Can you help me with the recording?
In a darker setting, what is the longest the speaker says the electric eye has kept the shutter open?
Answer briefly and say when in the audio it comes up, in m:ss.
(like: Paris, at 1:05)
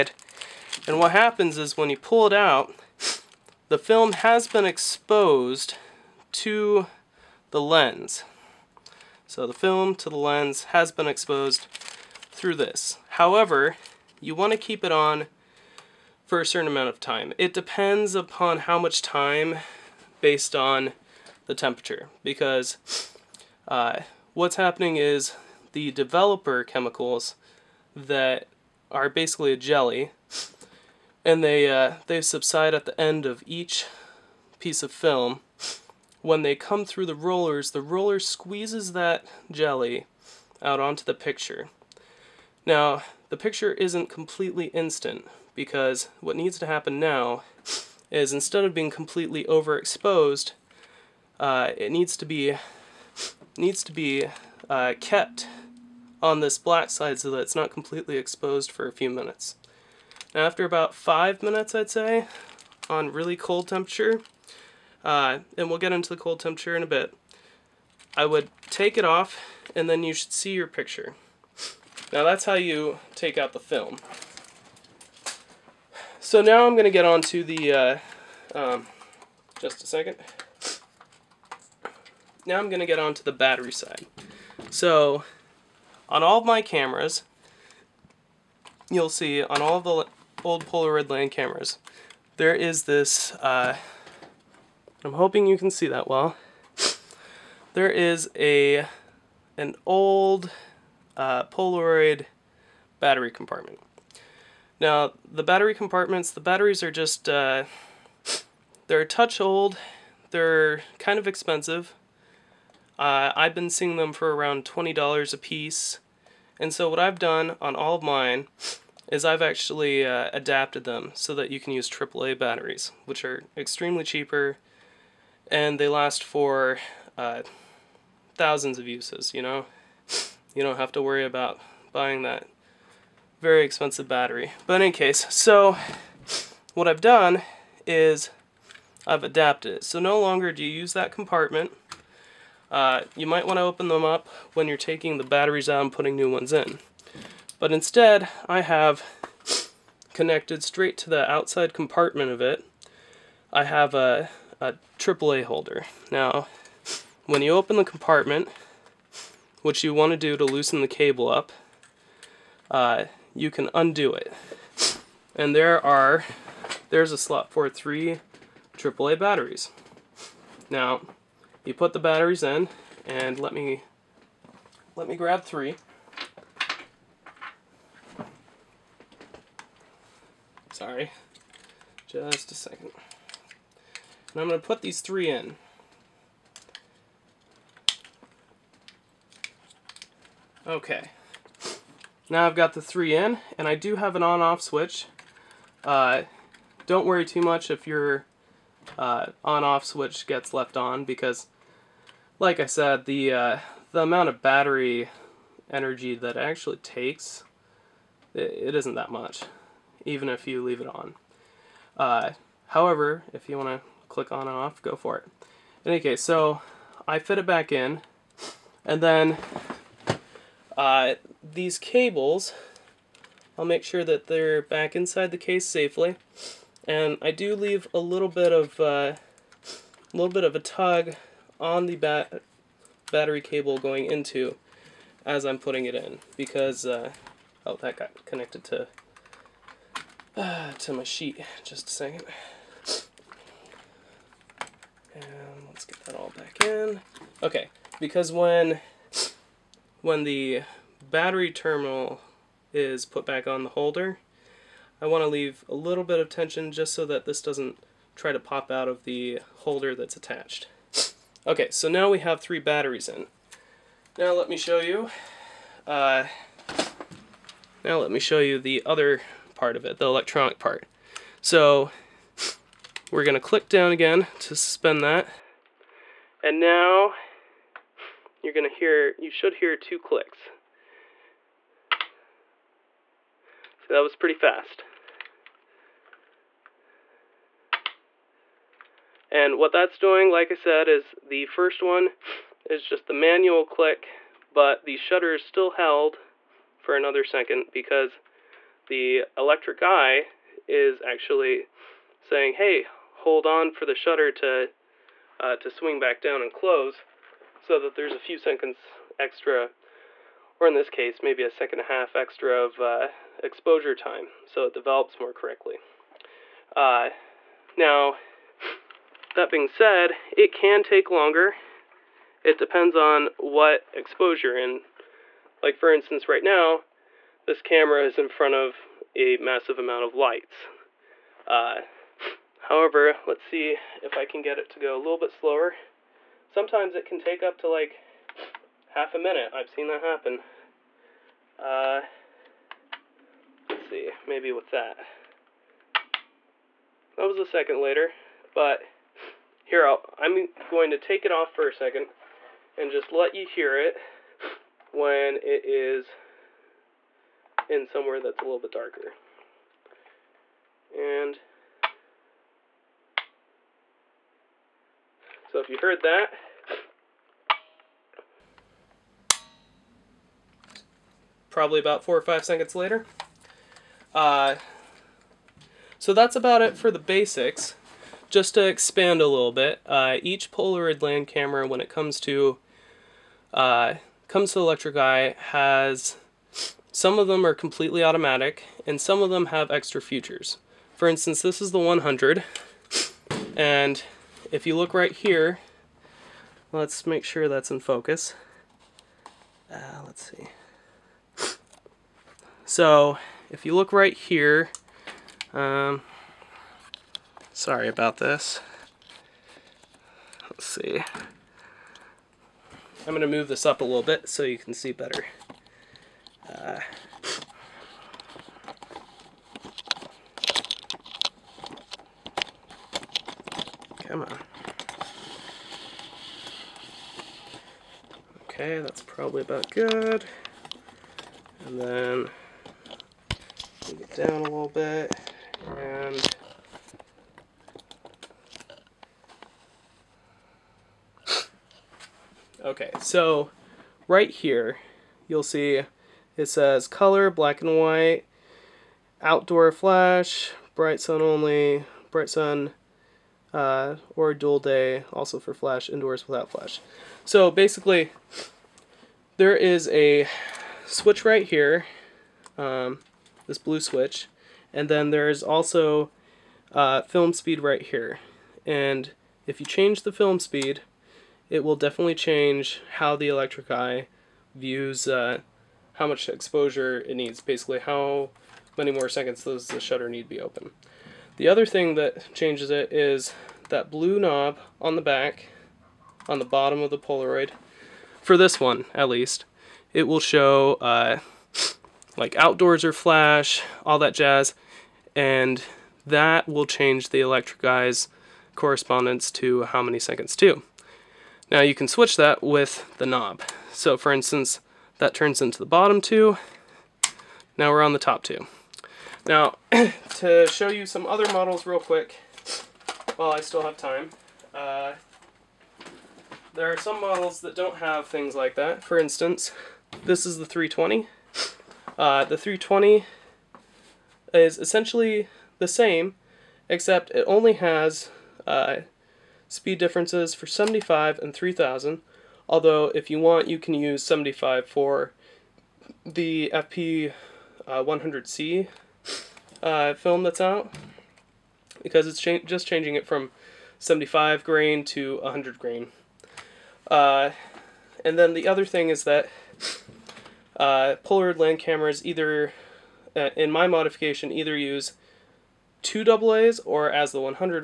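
half a minute, at 5:38.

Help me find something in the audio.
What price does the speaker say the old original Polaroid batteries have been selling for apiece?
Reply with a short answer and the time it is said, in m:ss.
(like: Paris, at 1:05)
$20, at 1:54.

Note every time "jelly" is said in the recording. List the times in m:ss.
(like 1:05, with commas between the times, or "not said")
0:29, 0:39.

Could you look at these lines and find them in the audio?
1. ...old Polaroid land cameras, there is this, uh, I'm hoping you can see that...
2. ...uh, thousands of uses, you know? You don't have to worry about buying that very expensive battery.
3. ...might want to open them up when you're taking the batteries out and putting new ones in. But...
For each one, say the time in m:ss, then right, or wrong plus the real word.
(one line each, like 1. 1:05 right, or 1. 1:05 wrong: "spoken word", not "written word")
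1. 1:30 right
2. 2:07 right
3. 2:23 right.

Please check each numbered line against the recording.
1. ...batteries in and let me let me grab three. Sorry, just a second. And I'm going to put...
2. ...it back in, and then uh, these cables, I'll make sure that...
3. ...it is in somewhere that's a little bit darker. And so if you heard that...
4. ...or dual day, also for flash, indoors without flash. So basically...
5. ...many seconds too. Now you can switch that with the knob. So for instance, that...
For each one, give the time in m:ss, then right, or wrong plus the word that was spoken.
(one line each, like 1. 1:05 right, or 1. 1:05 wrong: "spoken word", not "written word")
1. 2:51 right
2. 3:37 right
3. 5:55 right
4. 7:34 right
5. 8:19 right.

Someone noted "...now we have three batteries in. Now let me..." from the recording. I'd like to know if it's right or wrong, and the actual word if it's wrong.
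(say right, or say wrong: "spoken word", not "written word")
right.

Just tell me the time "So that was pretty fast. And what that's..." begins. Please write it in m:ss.
4:43.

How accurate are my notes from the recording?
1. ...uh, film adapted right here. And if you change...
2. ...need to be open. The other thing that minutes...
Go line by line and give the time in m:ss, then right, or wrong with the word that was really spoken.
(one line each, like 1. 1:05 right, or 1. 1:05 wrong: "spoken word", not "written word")
1. 7:46 wrong: "speed", not "adapted"
2. 8:00 wrong: "changes", not "minutes".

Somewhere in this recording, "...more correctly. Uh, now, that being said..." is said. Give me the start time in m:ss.
5:15.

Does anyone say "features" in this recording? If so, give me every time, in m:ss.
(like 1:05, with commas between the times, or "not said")
6:30.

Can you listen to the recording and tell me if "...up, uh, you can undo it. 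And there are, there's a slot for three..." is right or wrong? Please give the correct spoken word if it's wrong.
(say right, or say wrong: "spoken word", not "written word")
right.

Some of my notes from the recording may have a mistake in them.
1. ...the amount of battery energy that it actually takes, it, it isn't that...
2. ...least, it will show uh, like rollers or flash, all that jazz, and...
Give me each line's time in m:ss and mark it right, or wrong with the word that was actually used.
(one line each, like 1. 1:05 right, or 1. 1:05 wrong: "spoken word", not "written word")
1. 3:23 right
2. 8:09 wrong: "outdoors", not "rollers".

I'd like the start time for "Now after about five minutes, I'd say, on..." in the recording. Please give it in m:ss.
1:00.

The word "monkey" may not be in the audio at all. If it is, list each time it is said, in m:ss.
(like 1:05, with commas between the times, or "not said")
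not said.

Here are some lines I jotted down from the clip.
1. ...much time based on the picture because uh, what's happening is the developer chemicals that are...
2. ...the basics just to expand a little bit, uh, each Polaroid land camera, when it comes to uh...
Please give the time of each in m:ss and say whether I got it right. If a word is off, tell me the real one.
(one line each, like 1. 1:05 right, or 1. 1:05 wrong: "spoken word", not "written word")
1. 0:18 wrong: "temperature", not "picture"
2. 6:16 right.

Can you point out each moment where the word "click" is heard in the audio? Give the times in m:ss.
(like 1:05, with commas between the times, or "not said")
3:34, 4:33, 4:39, 4:53.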